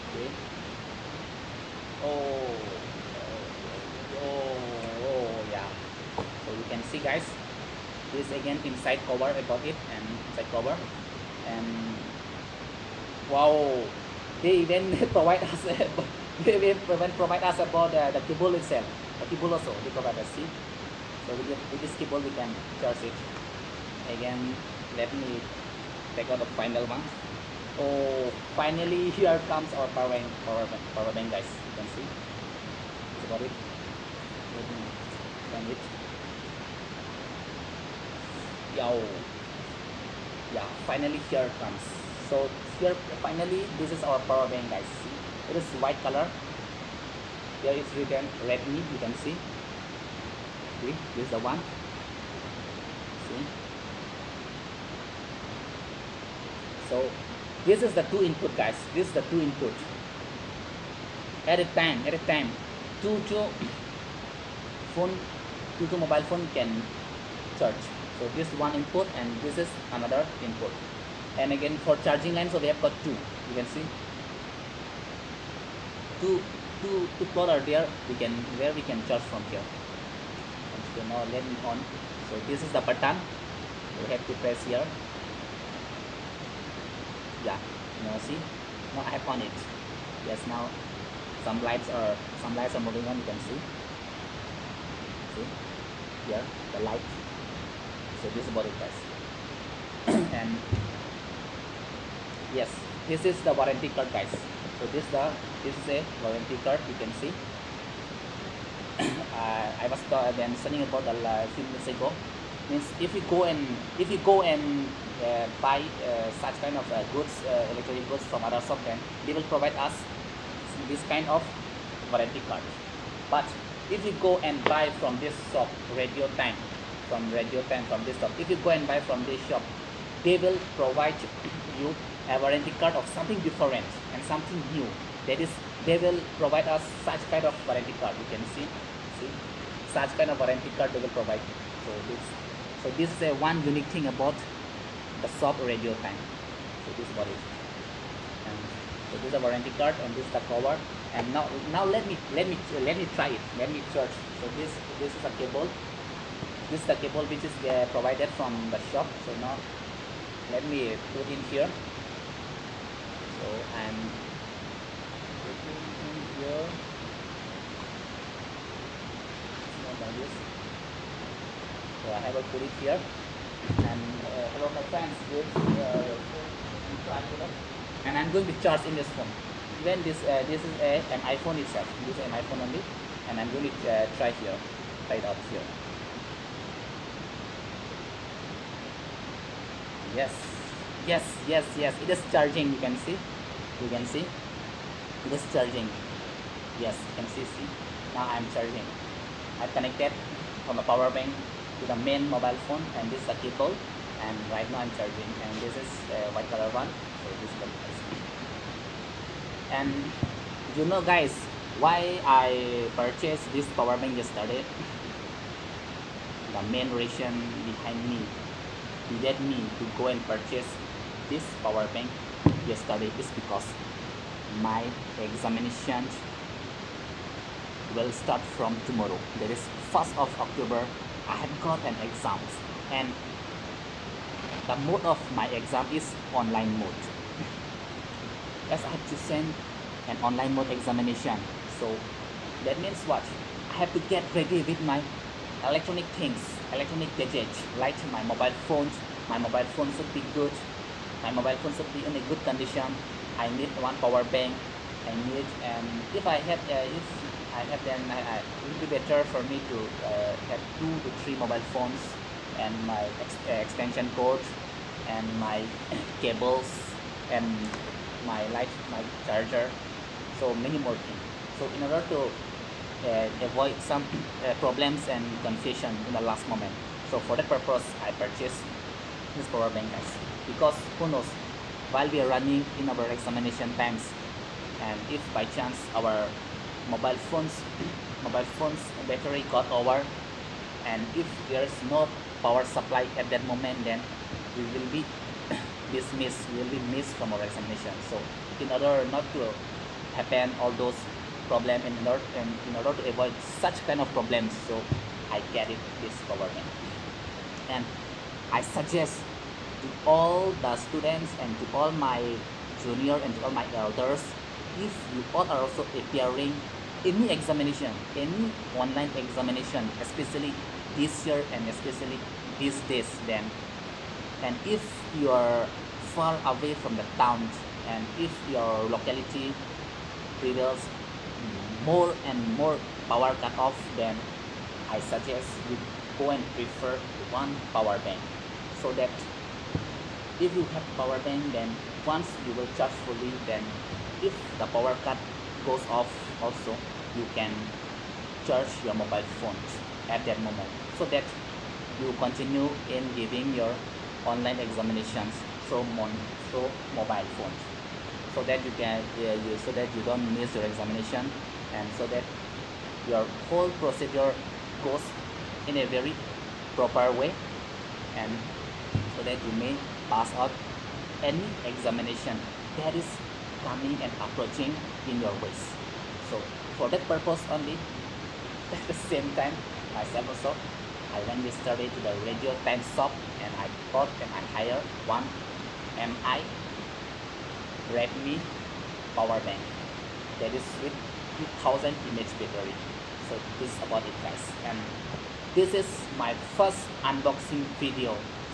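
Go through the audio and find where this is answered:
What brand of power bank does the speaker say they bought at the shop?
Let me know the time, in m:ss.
6:25.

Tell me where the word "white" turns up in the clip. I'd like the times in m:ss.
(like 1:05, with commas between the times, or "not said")
0:45, 3:26.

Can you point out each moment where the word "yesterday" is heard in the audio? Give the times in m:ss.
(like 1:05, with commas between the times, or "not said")
3:34, 3:42, 6:21.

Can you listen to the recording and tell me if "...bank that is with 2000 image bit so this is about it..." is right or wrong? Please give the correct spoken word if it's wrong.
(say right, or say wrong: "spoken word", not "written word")
right.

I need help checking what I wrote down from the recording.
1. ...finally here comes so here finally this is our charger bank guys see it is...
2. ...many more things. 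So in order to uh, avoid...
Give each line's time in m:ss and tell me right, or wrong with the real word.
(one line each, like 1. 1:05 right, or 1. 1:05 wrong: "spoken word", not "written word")
1. 0:40 wrong: "power", not "charger"
2. 4:30 right.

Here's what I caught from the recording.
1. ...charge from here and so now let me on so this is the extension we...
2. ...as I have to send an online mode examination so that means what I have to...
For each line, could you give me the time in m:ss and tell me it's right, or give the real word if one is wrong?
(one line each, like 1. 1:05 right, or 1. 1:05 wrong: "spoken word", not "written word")
1. 1:19 wrong: "button", not "extension"
2. 3:58 right.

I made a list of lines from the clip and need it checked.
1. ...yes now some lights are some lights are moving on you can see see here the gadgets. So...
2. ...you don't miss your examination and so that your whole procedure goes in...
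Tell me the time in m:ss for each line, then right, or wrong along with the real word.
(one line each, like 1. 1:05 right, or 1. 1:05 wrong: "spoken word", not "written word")
1. 1:30 wrong: "lights", not "gadgets"
2. 5:59 right.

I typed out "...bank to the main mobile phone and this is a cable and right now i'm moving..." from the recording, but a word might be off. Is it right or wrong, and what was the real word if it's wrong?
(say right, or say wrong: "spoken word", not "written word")
wrong: "charging", not "moving".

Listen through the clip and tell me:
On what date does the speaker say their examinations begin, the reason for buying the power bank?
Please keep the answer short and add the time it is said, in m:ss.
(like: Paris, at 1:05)
1st of October, at 3:49.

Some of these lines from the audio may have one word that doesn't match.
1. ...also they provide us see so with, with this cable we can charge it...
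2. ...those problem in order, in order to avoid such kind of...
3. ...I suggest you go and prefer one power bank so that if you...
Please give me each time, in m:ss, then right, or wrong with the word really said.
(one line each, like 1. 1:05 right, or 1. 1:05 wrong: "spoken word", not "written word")
1. 0:19 right
2. 5:00 right
3. 5:34 right.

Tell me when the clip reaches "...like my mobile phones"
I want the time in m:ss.
4:07.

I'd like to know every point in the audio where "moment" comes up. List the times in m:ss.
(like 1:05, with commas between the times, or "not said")
4:36, 4:53, 5:50.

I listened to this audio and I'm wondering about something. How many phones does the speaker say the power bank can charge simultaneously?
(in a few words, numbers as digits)
2.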